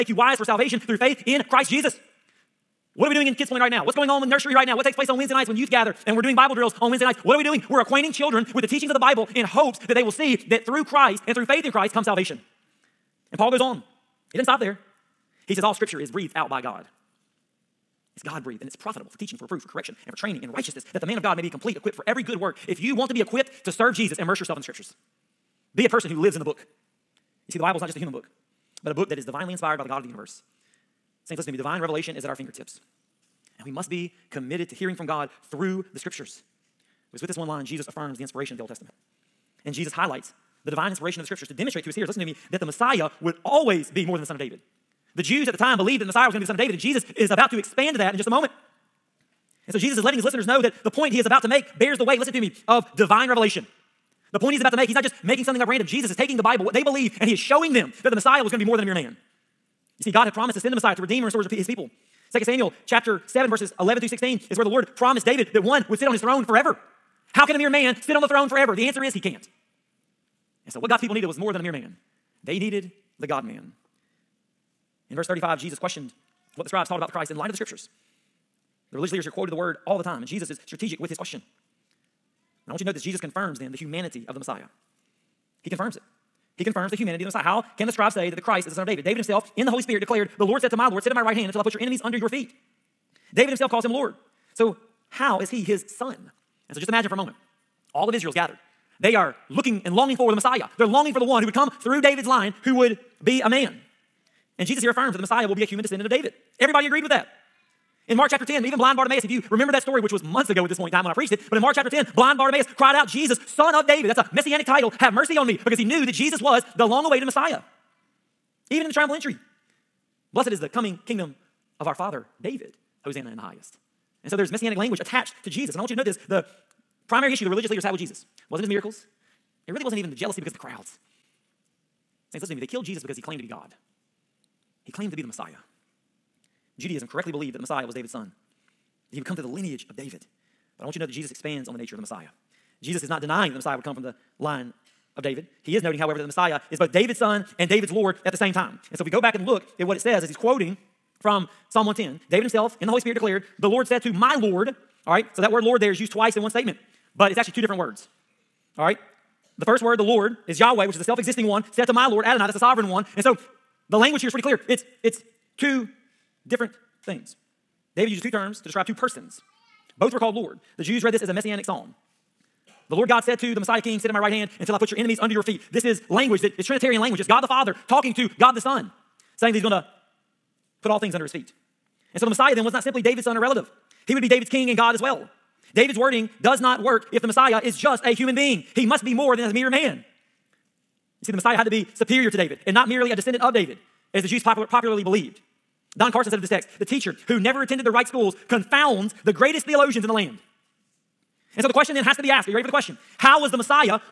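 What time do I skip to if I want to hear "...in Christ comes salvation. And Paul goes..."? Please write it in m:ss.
0:11.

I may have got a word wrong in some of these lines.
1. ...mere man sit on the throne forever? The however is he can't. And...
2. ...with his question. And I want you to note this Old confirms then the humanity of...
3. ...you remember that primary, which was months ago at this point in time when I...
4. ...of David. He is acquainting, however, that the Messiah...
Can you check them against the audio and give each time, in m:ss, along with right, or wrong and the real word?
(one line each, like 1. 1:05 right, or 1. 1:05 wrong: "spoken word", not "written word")
1. 1:07 wrong: "answer", not "however"
2. 1:20 wrong: "Jesus", not "Old"
3. 1:49 wrong: "story", not "primary"
4. 2:25 wrong: "noting", not "acquainting".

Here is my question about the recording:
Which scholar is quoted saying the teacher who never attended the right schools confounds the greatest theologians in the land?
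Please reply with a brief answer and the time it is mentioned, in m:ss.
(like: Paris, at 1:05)
Don Carson, at 3:15.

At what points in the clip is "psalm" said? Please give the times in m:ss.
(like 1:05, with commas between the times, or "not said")
2:31, 2:51.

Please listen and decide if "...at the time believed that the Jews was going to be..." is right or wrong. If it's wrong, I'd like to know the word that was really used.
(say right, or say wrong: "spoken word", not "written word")
wrong: "Messiah", not "Jews".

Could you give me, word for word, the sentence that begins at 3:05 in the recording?
David's wording does not work if the Messiah is just a human being.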